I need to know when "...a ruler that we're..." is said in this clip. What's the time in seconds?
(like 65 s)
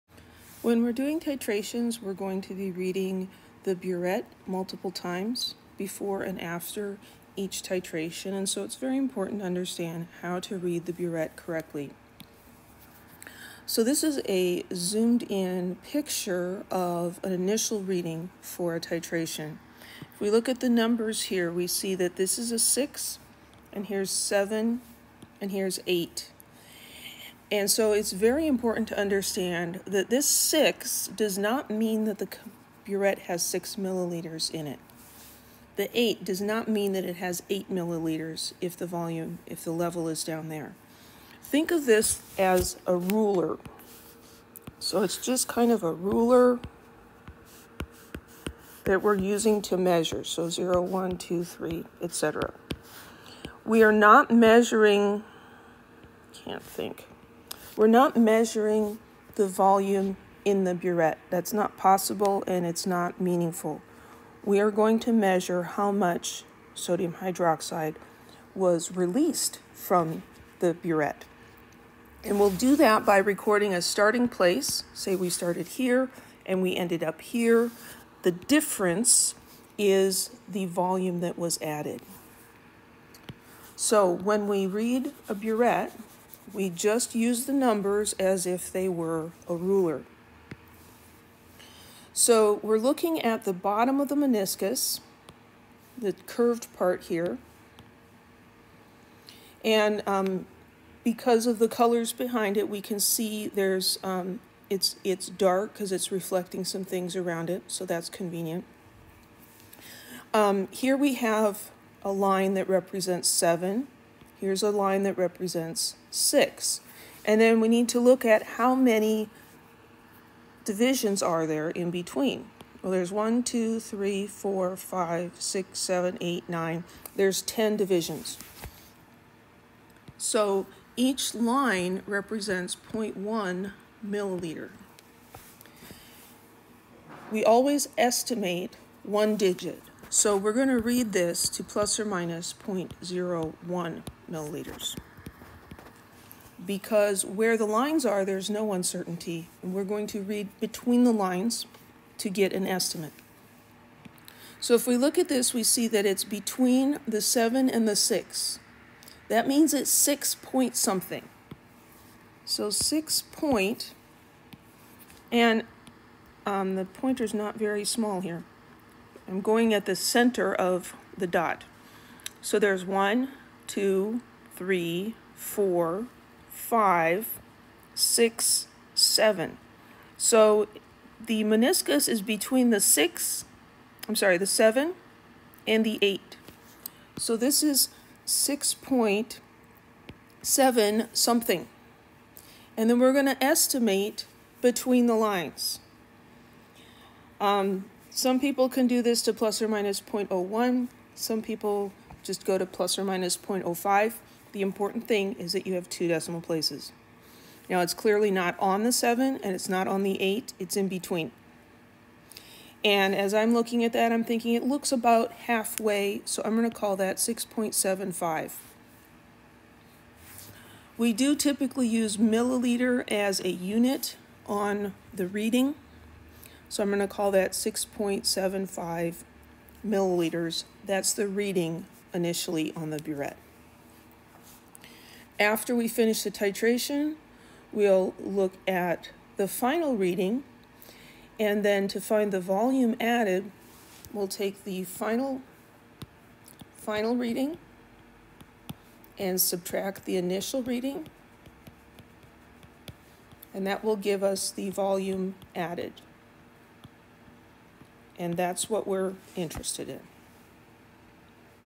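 45 s.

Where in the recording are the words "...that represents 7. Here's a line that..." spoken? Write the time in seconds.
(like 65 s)
112 s.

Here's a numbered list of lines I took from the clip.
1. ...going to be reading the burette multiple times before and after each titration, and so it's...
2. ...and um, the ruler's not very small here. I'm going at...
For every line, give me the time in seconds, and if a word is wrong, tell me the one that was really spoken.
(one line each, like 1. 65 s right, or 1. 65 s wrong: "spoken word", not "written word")
1. 2 s right
2. 165 s wrong: "pointer", not "ruler".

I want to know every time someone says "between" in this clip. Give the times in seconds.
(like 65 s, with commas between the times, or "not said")
121 s, 150 s, 156 s, 182 s, 194 s, 210 s.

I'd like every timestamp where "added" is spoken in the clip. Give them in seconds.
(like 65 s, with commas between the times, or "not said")
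81 s, 243 s, 255 s.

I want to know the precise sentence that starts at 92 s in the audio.
So we're looking at the bottom of the meniscus, the curved part here.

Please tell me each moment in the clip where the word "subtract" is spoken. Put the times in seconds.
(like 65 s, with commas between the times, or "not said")
249 s.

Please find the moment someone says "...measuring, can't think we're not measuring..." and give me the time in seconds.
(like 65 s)
54 s.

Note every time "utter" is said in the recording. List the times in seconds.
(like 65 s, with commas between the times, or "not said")
not said.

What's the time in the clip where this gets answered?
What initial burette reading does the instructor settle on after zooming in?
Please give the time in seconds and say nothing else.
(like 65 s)
227 s.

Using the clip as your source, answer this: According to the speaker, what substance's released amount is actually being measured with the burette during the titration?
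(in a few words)
sodium hydroxide.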